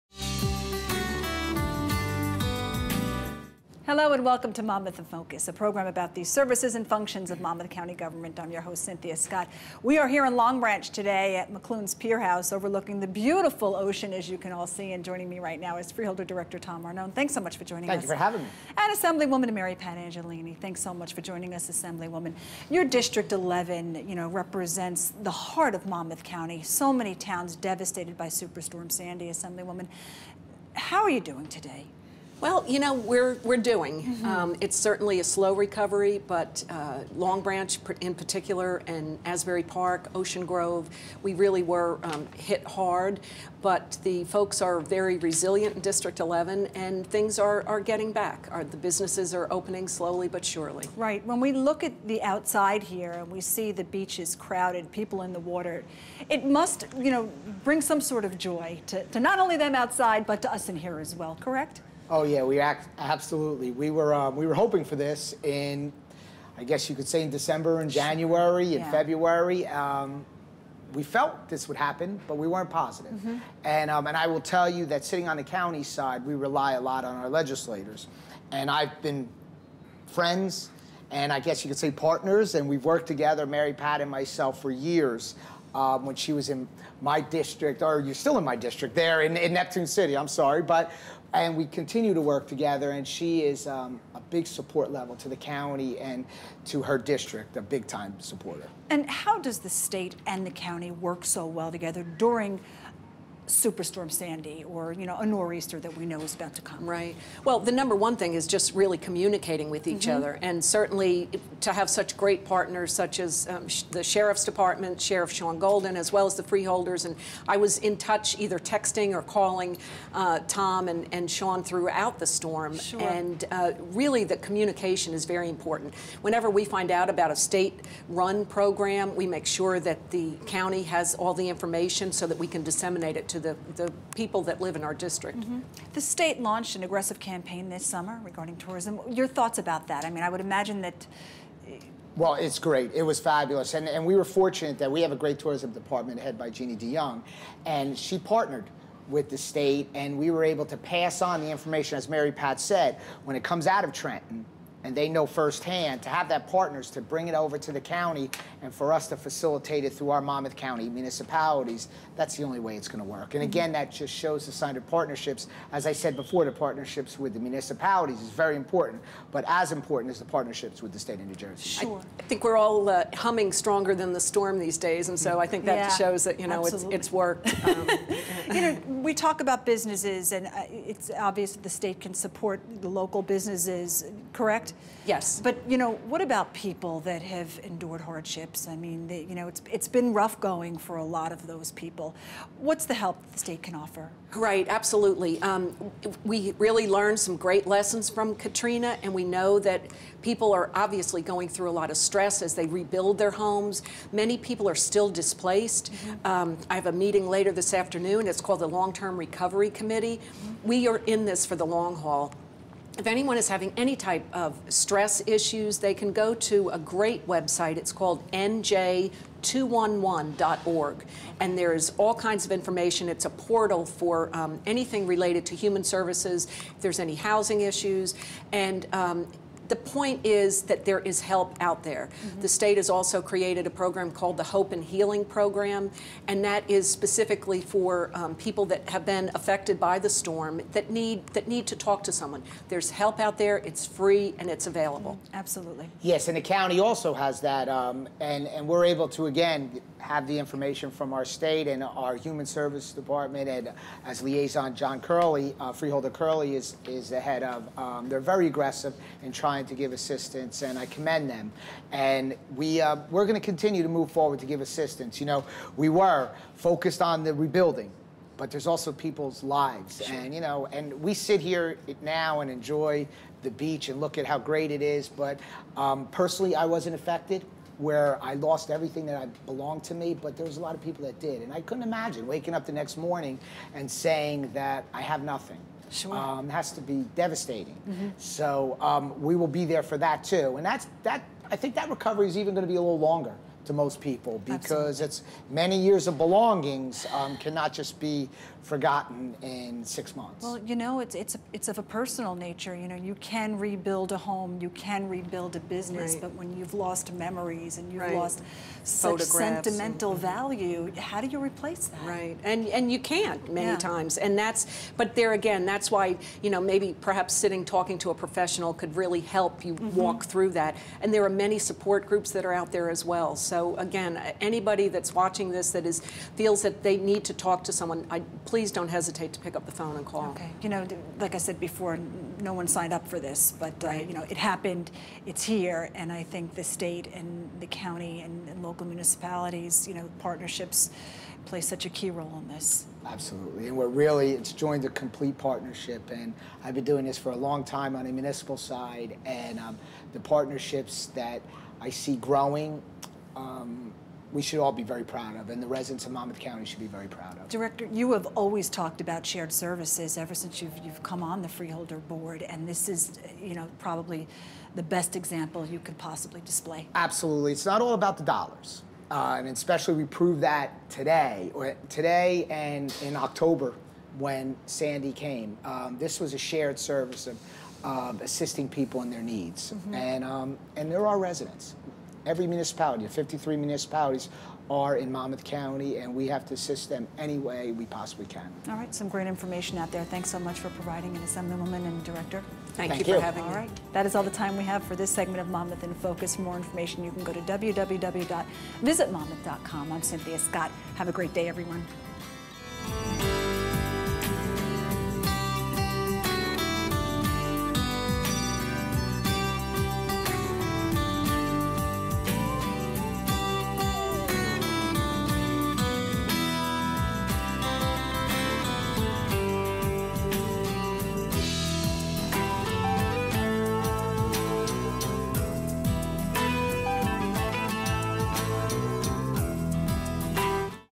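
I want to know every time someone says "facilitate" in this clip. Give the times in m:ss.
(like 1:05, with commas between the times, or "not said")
2:39.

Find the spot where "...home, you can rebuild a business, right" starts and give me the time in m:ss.
5:04.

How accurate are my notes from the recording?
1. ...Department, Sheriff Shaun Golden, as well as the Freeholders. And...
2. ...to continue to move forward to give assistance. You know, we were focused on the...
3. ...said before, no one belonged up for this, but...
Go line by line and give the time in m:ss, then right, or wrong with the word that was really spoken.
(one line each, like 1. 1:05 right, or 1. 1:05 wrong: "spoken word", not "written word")
1. 1:54 right
2. 4:23 right
3. 5:31 wrong: "signed", not "belonged".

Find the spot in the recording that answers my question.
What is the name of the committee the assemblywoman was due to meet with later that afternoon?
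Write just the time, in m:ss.
3:28.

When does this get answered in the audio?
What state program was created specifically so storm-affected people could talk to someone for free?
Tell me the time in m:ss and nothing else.
3:54.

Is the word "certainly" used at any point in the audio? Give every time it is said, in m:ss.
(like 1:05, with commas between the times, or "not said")
0:34, 1:50.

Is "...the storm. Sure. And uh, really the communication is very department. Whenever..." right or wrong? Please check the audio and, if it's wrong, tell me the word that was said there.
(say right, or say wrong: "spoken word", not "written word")
wrong: "important", not "department".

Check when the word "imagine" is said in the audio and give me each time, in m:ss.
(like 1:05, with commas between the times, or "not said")
2:20, 4:41.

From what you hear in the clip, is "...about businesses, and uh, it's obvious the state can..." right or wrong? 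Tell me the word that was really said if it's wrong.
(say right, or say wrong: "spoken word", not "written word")
right.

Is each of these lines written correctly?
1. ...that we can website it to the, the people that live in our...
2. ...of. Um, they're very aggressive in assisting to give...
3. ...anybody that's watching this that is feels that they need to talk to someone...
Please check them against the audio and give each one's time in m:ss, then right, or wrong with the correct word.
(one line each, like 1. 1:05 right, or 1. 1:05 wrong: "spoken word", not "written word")
1. 2:12 wrong: "disseminate", not "website"
2. 4:17 wrong: "trying", not "assisting"
3. 5:24 right.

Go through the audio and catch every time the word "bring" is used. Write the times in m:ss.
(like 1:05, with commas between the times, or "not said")
0:57, 2:37.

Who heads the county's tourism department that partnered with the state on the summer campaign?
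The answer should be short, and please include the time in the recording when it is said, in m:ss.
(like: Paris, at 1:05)
Jeannie DeYoung, at 2:26.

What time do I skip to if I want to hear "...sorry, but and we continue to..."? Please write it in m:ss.
1:30.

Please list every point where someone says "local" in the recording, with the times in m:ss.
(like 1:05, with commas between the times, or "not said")
3:02, 5:38.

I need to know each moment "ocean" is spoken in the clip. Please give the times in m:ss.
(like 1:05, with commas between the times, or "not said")
0:13, 0:40.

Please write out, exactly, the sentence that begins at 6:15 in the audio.
Um, this was a shared service of, of assisting people in their needs, mm -hmm.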